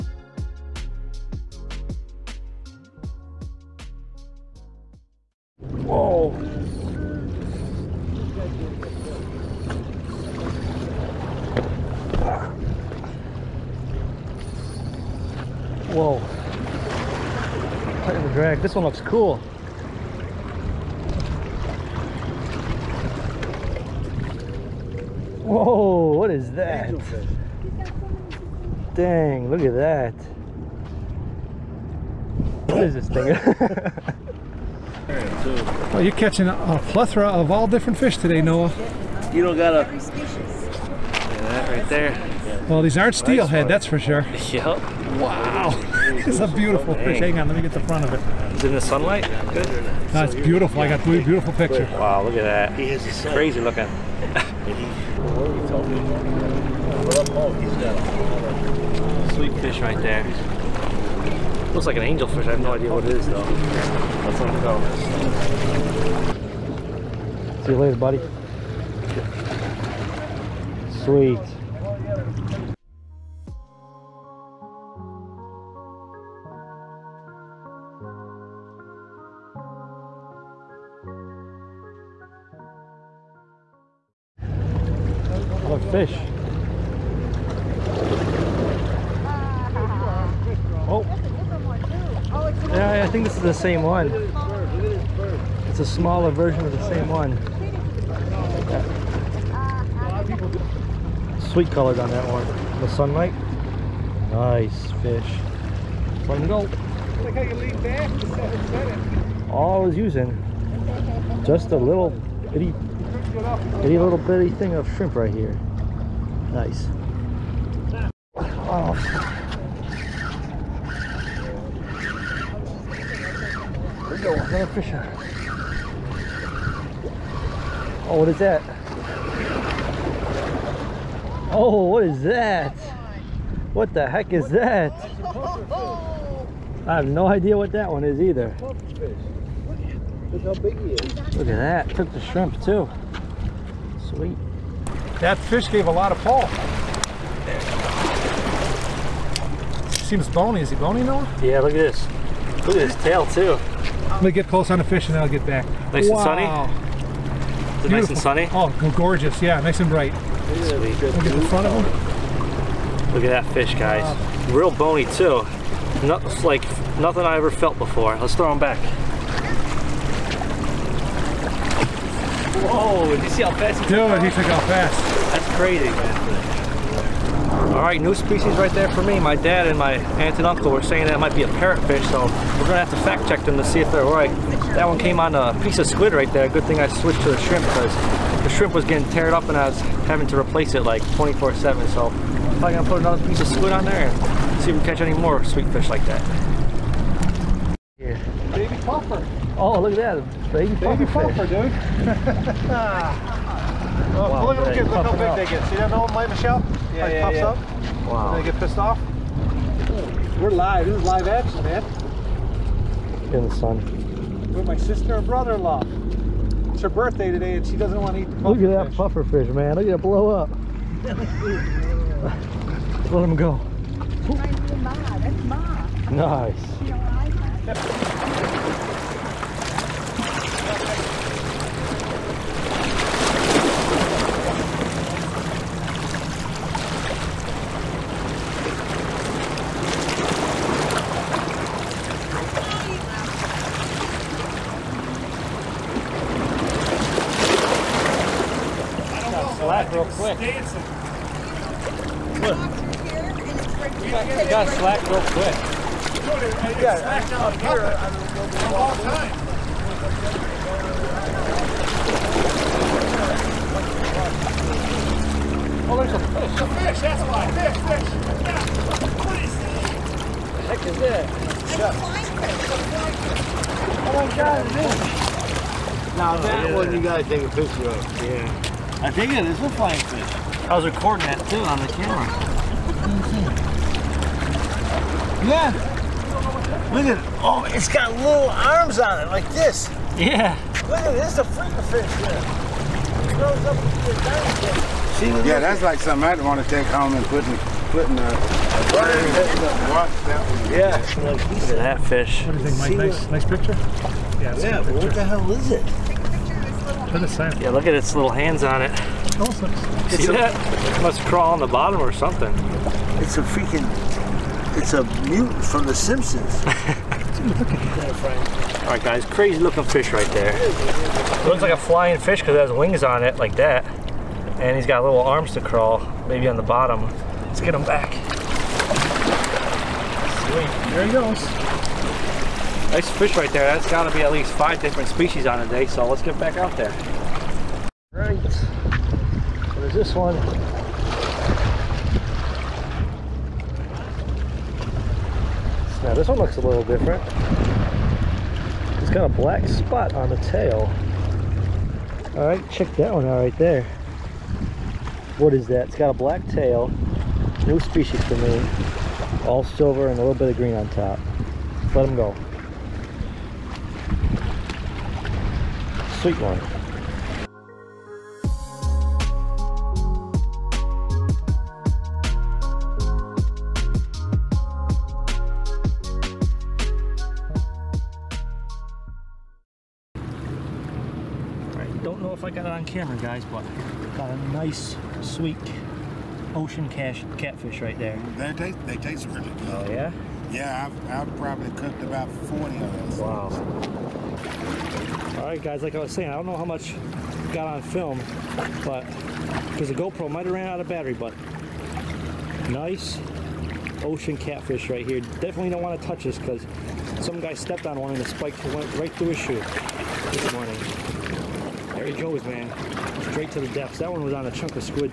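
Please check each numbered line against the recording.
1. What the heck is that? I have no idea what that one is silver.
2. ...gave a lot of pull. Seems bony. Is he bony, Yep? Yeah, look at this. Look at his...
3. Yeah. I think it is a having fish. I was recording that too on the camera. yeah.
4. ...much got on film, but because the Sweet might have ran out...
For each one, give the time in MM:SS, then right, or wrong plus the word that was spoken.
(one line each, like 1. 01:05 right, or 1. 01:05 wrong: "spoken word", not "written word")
1. 02:13 wrong: "either", not "silver"
2. 02:25 wrong: "Noah", not "Yep"
3. 04:38 wrong: "flying", not "having"
4. 06:36 wrong: "GoPro", not "Sweet".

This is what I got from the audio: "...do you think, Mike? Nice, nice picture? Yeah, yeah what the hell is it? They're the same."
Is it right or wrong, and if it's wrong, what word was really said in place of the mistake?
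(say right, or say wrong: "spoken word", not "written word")
right.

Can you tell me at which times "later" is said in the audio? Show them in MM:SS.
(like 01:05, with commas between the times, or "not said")
01:07.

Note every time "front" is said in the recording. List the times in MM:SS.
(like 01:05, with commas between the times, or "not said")
00:47, 02:41.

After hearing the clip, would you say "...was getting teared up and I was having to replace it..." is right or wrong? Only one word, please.
right.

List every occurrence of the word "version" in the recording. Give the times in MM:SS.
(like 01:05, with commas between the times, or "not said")
01:36.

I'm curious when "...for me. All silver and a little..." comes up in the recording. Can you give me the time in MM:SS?
05:58.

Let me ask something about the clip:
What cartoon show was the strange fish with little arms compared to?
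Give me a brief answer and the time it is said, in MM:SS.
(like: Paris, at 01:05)
The Simpsons, at 05:15.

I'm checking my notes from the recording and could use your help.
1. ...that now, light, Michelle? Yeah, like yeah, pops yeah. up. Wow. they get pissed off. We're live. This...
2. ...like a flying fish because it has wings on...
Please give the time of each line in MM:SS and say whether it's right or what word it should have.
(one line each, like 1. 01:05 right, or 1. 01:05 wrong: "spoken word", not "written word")
1. 03:25 right
2. 05:21 right.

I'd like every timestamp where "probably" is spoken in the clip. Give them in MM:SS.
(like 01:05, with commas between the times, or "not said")
03:12, 06:31.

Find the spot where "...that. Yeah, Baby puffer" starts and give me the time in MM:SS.
03:16.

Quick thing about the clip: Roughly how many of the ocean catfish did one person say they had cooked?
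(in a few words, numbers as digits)
40.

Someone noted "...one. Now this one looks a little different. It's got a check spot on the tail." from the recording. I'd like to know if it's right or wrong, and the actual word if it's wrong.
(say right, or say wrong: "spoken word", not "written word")
wrong: "black", not "check".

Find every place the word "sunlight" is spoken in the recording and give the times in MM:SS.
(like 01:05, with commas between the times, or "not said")
00:48, 01:42.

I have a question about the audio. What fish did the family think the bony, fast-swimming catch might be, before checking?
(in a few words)
parrotfish.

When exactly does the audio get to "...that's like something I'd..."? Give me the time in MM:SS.
04:55.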